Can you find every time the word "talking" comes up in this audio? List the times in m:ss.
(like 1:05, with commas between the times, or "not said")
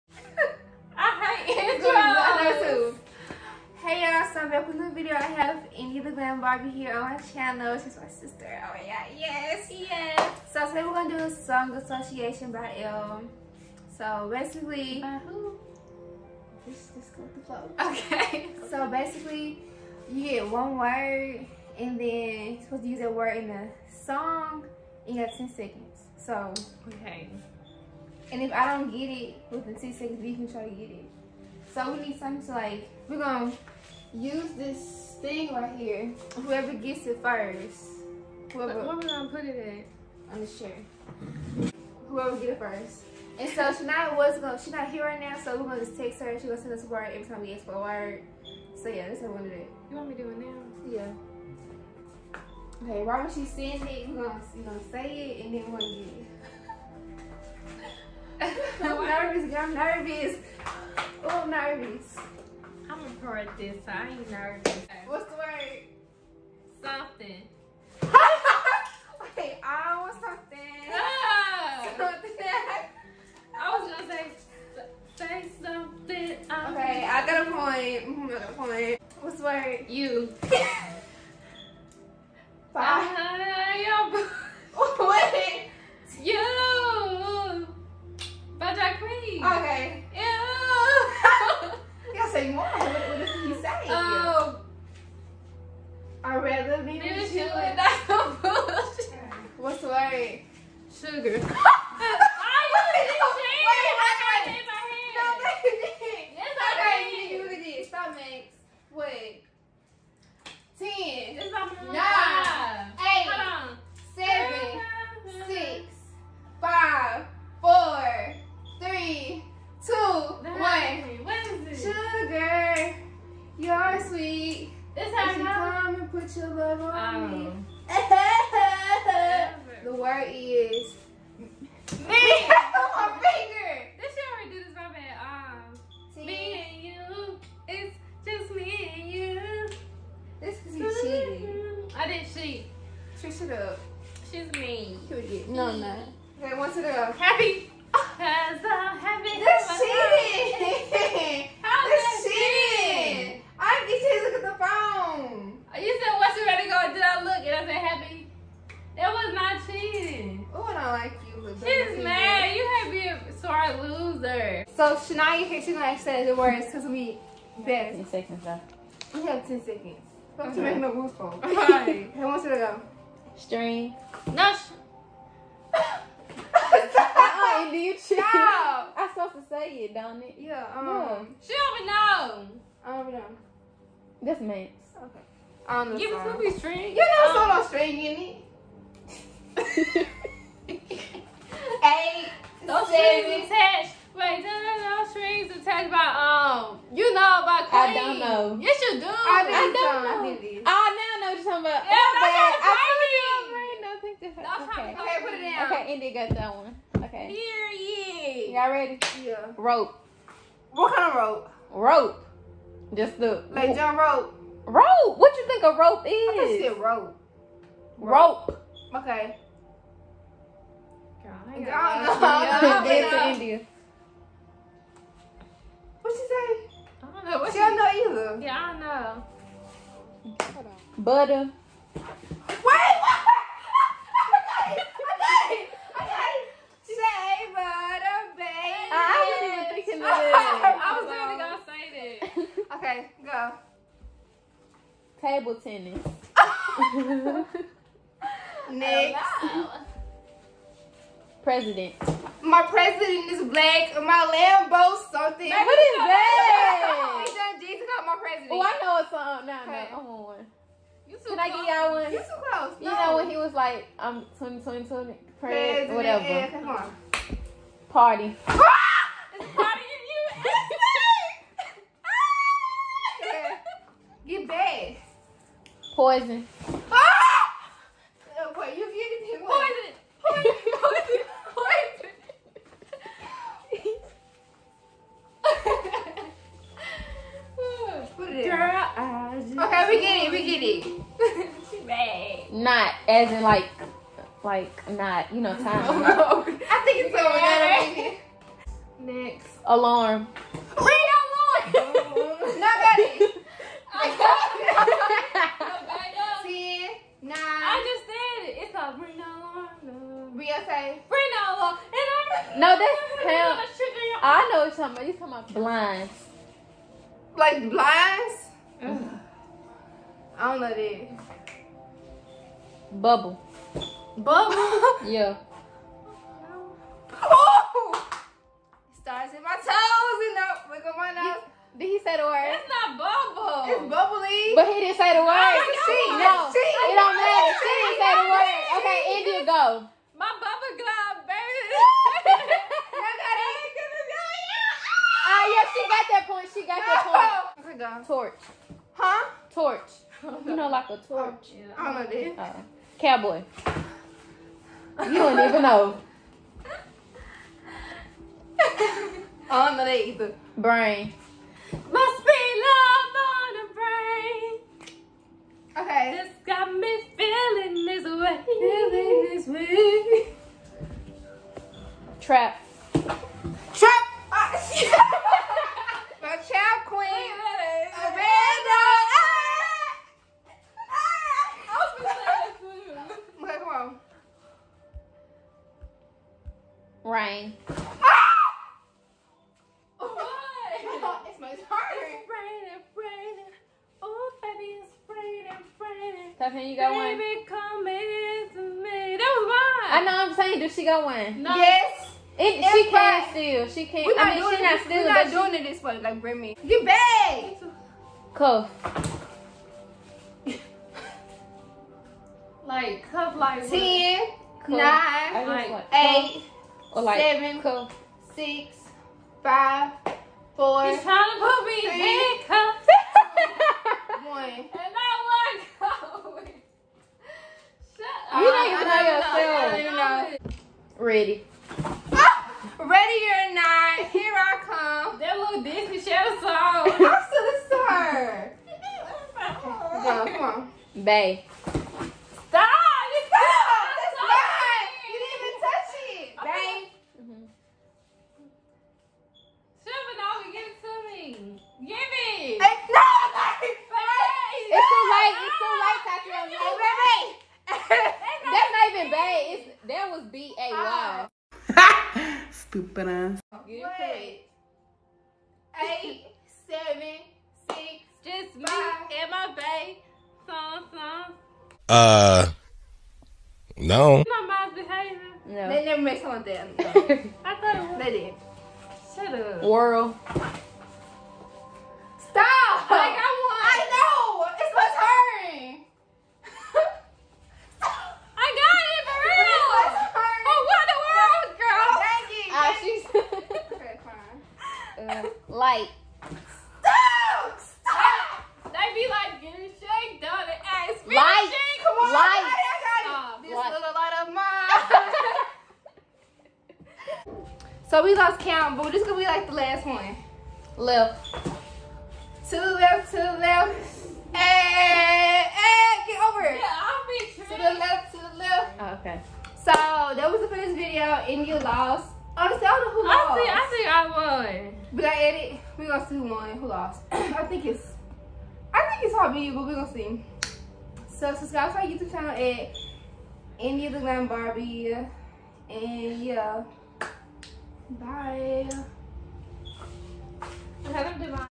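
3:21, 5:15.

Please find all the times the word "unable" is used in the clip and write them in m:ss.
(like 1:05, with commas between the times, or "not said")
not said.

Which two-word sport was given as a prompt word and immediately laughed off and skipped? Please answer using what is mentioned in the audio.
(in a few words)
Table tennis.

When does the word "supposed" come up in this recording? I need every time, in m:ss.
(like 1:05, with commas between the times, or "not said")
0:22, 2:59.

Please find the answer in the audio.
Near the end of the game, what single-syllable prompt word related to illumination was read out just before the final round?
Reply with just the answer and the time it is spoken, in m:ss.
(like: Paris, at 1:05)
Light, at 8:15.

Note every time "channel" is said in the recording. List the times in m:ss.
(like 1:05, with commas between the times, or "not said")
0:07, 8:52.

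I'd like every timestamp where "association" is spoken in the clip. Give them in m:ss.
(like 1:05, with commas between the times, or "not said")
0:11.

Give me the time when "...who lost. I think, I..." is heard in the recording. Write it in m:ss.
8:43.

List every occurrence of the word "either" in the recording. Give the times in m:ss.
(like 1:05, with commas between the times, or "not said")
3:47, 6:00.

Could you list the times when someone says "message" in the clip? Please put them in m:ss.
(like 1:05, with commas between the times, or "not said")
not said.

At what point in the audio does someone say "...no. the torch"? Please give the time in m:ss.
5:46.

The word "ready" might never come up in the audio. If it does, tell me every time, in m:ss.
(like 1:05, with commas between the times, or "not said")
2:36, 3:28, 7:10.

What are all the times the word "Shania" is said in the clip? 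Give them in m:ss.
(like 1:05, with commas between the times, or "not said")
0:43, 2:44.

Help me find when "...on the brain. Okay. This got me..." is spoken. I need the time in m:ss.
6:03.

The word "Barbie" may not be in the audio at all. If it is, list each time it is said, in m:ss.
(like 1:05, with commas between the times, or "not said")
0:06, 8:54.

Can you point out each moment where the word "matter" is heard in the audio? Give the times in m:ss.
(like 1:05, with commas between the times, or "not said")
5:37.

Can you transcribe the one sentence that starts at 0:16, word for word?
Just, just go with the flow.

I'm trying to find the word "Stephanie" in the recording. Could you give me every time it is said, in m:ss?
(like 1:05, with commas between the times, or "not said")
6:36.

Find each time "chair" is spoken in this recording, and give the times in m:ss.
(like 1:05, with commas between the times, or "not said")
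0:40.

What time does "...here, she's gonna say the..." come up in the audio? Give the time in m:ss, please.
2:45.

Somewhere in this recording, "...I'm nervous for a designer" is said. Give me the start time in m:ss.
1:01.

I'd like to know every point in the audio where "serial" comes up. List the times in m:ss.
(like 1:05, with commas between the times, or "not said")
not said.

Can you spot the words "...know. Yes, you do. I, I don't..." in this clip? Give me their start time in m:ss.
3:18.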